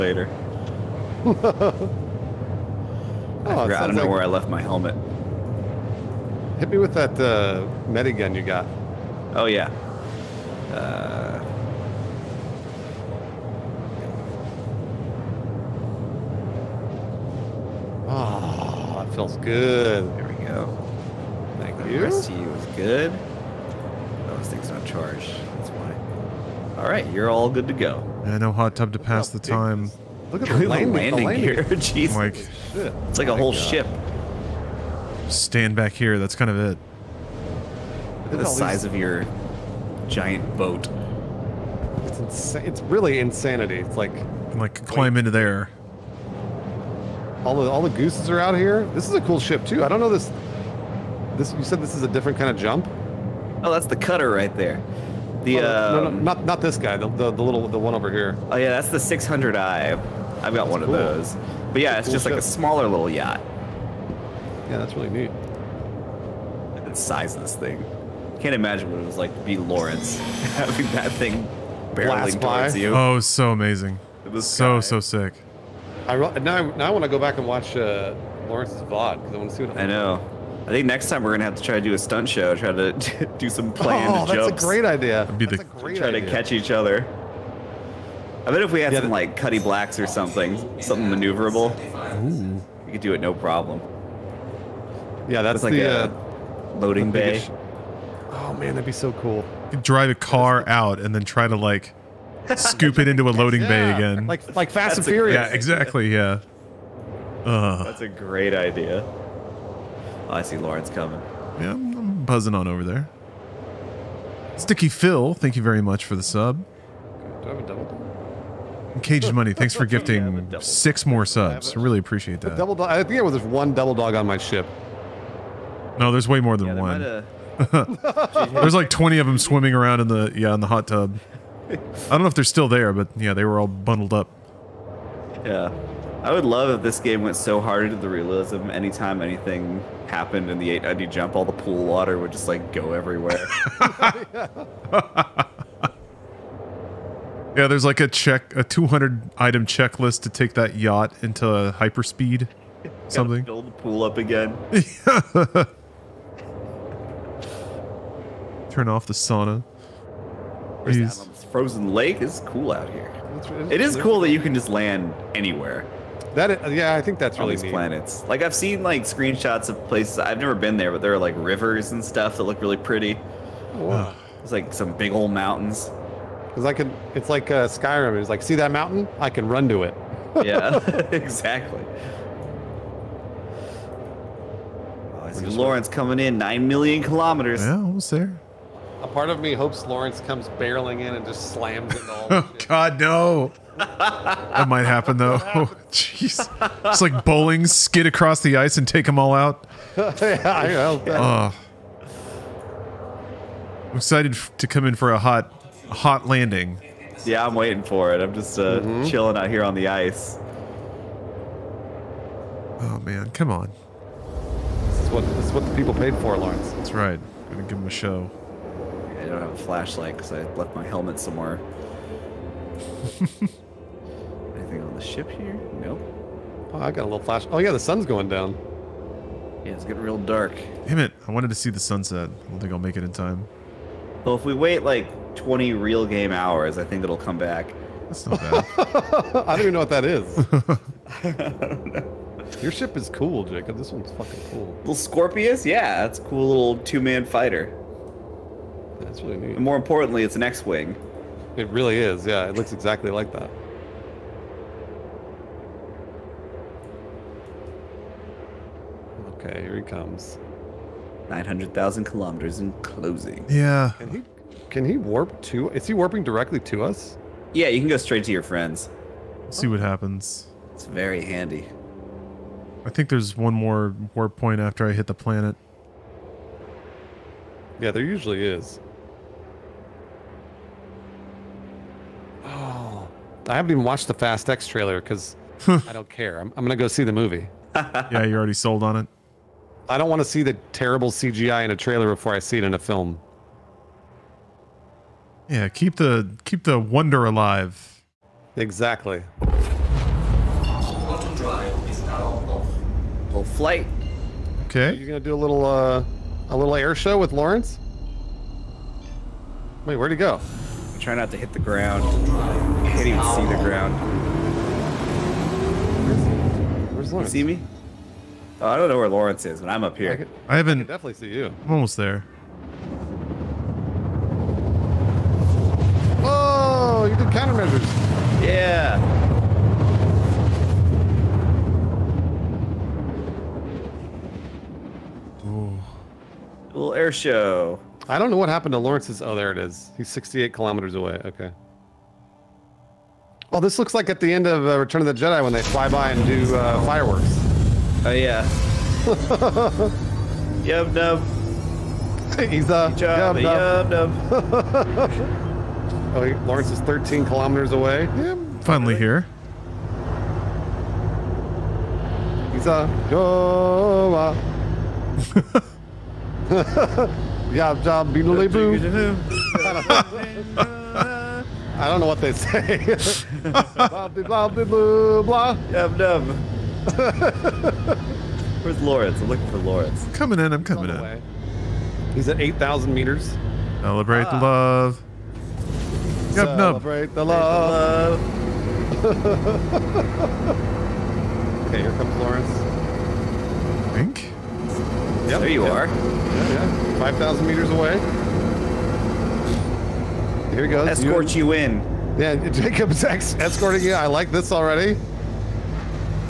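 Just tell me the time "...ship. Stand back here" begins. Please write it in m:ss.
0:33.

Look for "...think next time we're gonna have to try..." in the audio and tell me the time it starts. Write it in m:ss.
1:20.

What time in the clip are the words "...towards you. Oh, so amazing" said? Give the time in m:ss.
1:12.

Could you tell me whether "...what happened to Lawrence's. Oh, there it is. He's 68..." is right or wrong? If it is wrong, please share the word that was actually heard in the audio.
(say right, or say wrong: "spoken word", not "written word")
right.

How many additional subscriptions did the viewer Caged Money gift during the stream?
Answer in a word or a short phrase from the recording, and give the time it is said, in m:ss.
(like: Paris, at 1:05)
6, at 2:00.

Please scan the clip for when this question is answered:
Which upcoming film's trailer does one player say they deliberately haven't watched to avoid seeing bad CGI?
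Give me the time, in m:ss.
4:44.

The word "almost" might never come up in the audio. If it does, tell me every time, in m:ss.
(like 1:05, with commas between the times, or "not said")
3:07, 5:21.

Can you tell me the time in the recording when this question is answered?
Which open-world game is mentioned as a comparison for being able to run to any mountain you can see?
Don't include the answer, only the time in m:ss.
2:57.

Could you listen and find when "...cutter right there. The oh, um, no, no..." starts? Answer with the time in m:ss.
0:53.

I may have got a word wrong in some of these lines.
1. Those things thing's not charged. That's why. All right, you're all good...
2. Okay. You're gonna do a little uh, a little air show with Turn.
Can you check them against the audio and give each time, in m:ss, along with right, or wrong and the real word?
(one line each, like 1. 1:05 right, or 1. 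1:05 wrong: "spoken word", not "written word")
1. 0:24 right
2. 5:04 wrong: "Lawrence", not "Turn".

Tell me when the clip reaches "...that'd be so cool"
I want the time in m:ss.
1:38.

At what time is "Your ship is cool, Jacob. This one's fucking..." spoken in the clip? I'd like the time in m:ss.
4:02.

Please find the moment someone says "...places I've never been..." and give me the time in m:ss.
2:49.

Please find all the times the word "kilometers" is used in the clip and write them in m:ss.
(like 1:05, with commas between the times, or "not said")
3:07, 4:22, 5:40, 5:57.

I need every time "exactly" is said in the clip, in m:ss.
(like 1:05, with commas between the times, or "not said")
1:45, 3:01, 4:12, 4:58.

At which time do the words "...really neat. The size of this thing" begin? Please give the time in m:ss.
1:04.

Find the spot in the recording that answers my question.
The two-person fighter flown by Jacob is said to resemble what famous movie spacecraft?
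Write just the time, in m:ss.
4:10.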